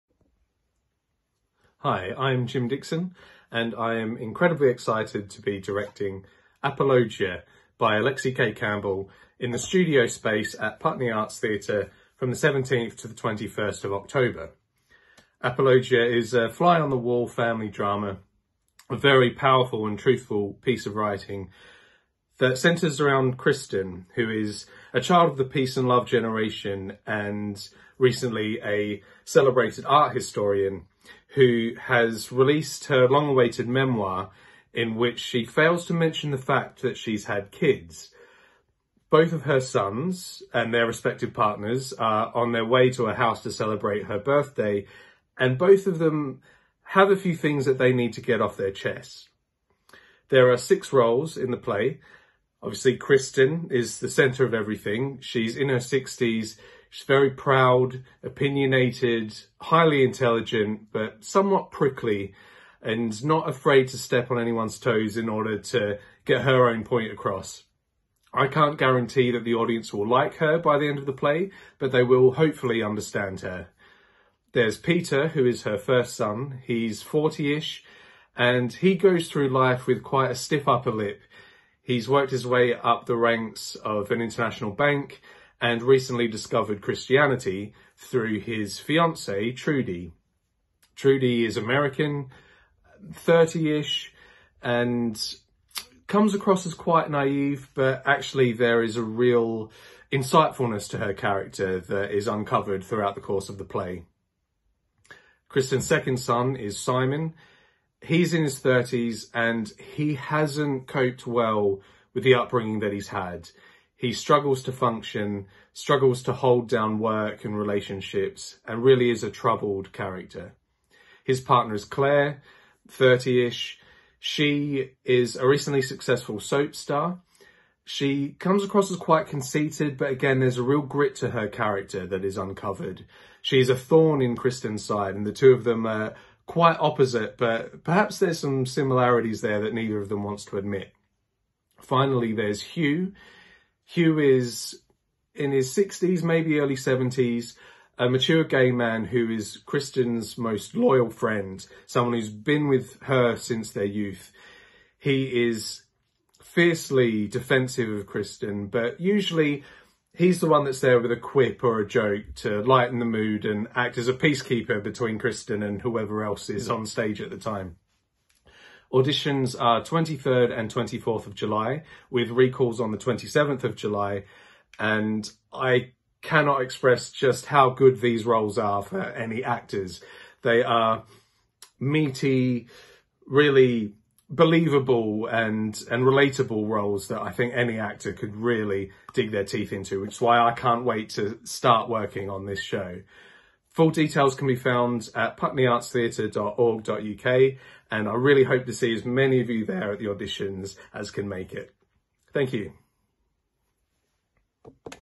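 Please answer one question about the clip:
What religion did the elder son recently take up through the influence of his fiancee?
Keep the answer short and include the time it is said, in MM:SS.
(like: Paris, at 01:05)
Christianity, at 01:26.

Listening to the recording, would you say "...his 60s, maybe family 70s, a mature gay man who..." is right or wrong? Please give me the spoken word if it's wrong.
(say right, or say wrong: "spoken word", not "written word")
wrong: "early", not "family".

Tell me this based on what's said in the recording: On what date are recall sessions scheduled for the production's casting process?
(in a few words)
27th of July.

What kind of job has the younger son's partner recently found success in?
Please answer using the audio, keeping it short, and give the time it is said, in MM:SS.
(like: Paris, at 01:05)
Soap star, at 02:06.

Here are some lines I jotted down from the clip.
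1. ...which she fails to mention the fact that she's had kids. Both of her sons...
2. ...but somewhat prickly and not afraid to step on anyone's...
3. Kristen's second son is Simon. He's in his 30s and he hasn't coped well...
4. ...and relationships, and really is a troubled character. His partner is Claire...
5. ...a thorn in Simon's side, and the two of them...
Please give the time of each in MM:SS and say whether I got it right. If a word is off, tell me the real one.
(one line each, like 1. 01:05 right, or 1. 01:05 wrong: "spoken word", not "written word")
1. 00:34 right
2. 01:00 right
3. 01:45 right
4. 01:57 right
5. 02:13 wrong: "Kristen", not "Simon".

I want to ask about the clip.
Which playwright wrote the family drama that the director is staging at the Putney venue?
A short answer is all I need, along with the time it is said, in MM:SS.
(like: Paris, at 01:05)
Alexi Kaye Campbell, at 00:07.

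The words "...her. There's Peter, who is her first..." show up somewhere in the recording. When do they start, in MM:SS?
01:13.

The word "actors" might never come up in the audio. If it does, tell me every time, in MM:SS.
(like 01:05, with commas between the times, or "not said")
02:59, 03:07.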